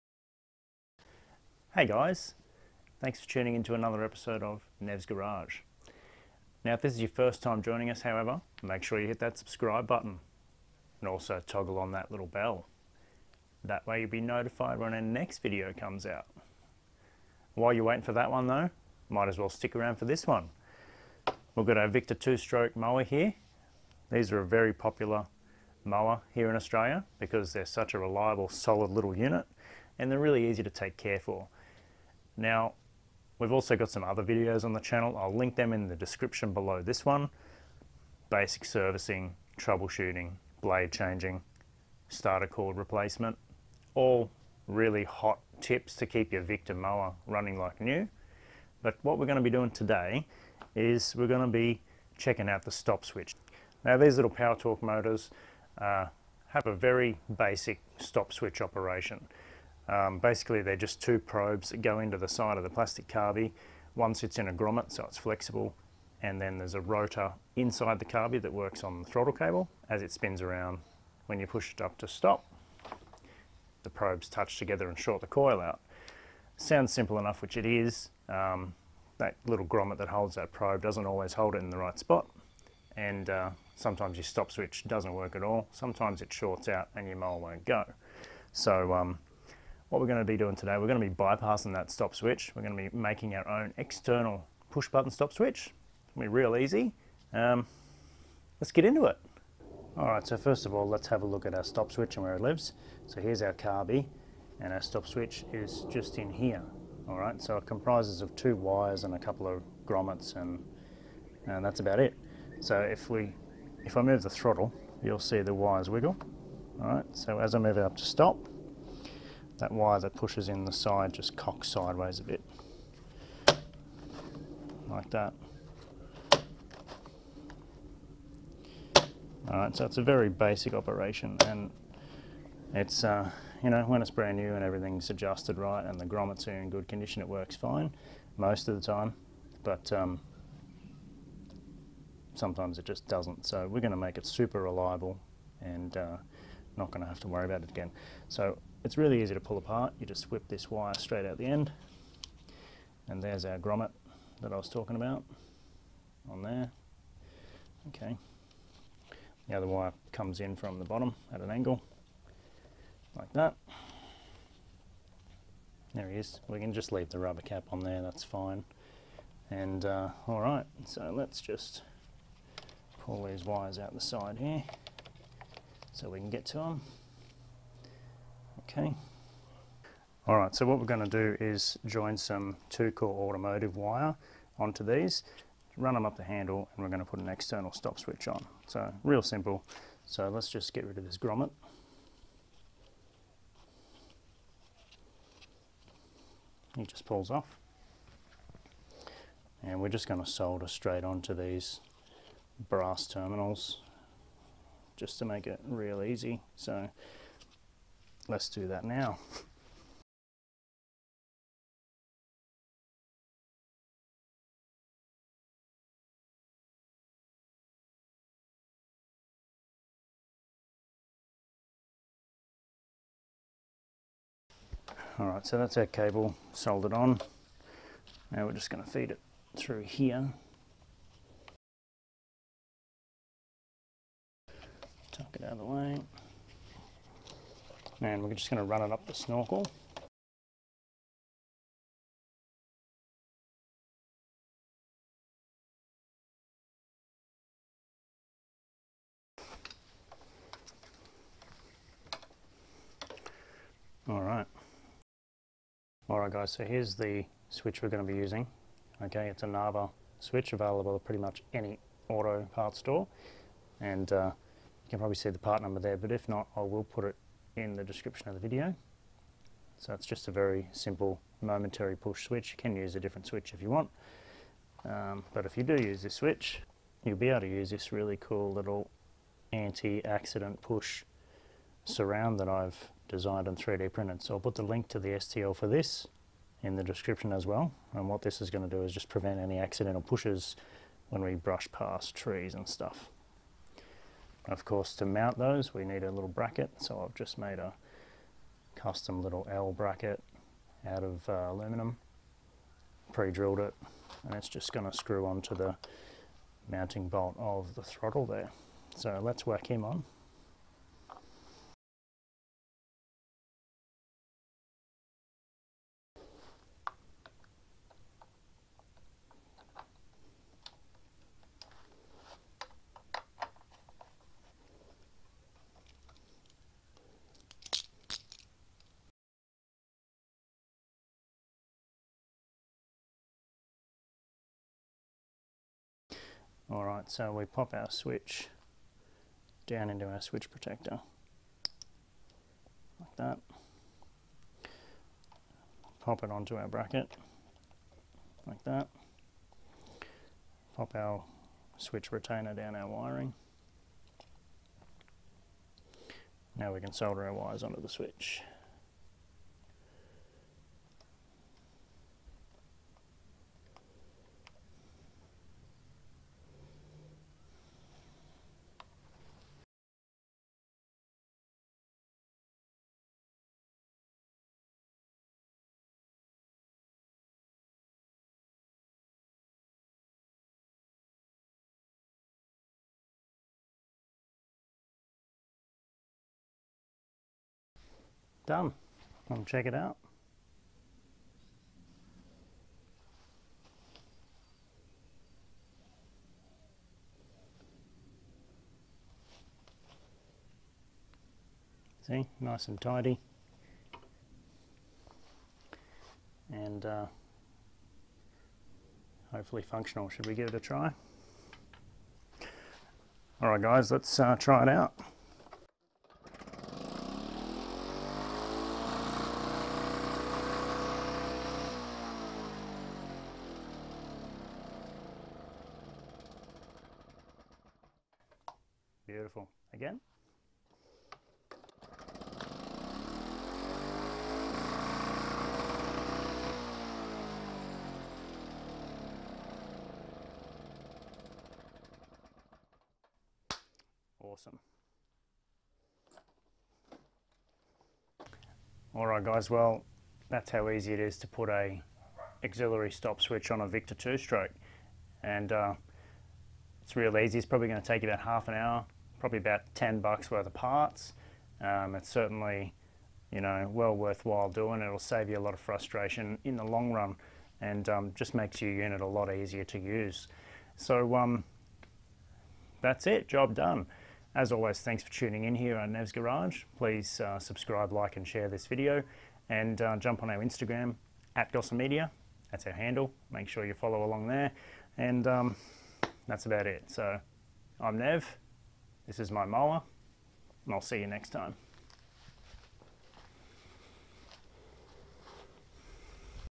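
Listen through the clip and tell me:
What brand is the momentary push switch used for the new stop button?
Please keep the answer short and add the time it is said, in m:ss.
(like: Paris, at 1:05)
Narva, at 4:19.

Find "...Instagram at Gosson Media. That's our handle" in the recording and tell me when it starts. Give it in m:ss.
8:00.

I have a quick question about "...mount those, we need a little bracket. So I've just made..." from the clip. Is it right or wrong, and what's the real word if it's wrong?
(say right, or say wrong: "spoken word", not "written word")
right.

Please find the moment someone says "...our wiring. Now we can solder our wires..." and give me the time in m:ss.
5:52.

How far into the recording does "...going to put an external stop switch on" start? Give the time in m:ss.
3:06.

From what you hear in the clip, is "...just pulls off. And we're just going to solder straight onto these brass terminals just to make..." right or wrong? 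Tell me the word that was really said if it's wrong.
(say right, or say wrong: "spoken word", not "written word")
right.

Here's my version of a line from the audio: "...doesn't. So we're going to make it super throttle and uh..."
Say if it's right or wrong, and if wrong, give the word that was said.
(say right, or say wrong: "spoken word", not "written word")
wrong: "reliable", not "throttle".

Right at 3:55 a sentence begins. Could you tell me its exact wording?
Tuck it out of the way and we're just going to run it up the snorkel.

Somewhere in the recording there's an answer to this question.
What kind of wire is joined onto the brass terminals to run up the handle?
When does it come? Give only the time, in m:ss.
3:02.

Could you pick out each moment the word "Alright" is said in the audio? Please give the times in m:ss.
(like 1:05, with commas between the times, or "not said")
1:39, 1:47, 1:56, 2:09.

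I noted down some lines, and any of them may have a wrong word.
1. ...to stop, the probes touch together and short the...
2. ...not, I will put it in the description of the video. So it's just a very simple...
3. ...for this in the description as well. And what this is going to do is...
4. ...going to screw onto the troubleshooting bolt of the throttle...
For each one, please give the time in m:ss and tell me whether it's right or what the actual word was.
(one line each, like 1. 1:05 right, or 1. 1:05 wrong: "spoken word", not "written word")
1. 1:11 right
2. 4:26 right
3. 4:45 right
4. 5:04 wrong: "mounting", not "troubleshooting".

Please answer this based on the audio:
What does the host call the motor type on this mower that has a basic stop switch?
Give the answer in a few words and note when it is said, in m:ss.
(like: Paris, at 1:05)
power torque, at 0:54.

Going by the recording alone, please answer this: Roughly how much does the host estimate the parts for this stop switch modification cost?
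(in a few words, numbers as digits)
10 bucks.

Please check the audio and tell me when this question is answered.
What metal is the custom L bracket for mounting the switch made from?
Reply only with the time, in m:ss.
5:01.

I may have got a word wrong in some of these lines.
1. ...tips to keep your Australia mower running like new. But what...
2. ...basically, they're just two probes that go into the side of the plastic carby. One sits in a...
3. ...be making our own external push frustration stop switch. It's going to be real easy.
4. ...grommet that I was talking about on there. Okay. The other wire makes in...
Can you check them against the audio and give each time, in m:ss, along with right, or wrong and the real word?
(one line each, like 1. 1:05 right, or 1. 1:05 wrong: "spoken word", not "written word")
1. 0:45 wrong: "Victa", not "Australia"
2. 1:00 right
3. 1:32 wrong: "button", not "frustration"
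4. 2:33 wrong: "comes", not "makes".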